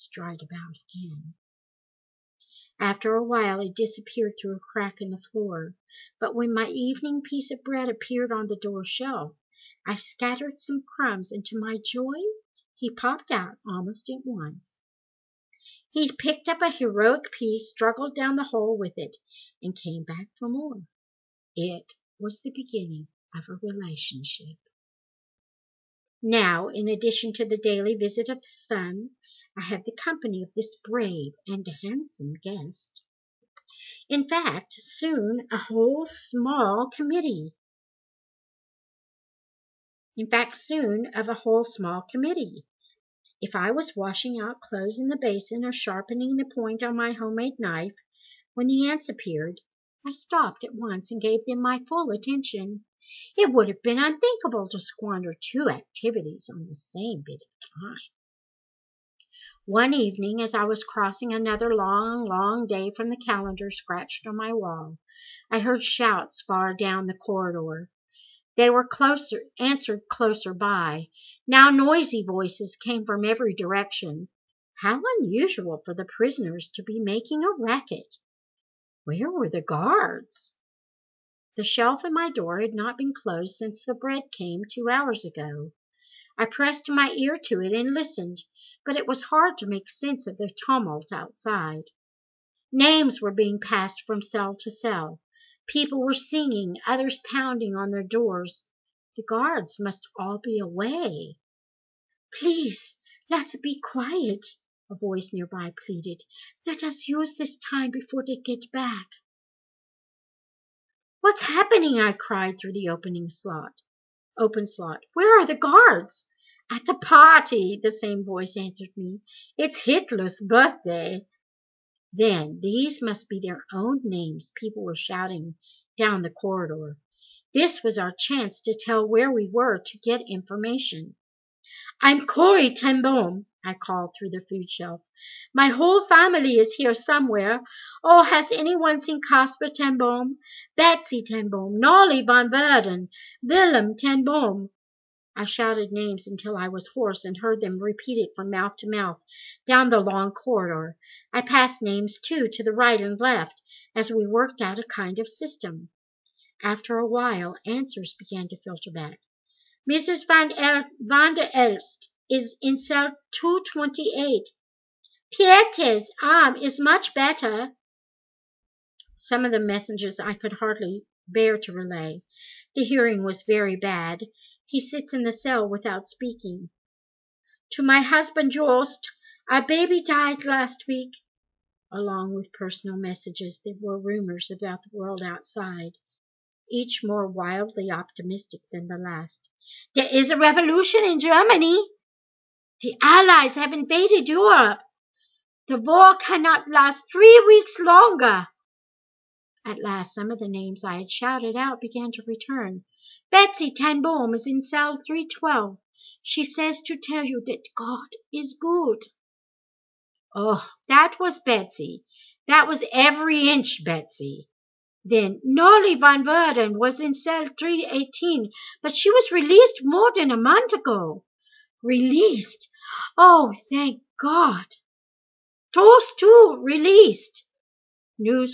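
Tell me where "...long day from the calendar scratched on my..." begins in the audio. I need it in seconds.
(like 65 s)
62 s.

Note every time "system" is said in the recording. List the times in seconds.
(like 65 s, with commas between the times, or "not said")
155 s.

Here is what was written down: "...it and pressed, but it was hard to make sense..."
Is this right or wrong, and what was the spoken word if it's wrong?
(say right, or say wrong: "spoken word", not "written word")
wrong: "listened", not "pressed".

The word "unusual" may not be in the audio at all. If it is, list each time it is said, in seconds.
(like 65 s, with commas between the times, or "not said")
75 s.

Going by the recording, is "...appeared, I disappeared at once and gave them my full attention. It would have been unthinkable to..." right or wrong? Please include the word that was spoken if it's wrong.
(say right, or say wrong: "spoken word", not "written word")
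wrong: "stopped", not "disappeared".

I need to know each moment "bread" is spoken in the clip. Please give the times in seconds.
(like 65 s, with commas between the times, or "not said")
7 s, 83 s.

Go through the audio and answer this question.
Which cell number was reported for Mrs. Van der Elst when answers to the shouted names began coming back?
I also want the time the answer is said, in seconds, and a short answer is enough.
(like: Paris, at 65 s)
228, at 163 s.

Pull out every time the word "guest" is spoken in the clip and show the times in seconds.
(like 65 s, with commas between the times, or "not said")
32 s.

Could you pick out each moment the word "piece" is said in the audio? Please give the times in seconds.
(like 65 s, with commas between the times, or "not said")
7 s, 17 s.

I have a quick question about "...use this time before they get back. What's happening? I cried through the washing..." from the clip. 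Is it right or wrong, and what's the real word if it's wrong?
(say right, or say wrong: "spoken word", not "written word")
wrong: "opening", not "washing".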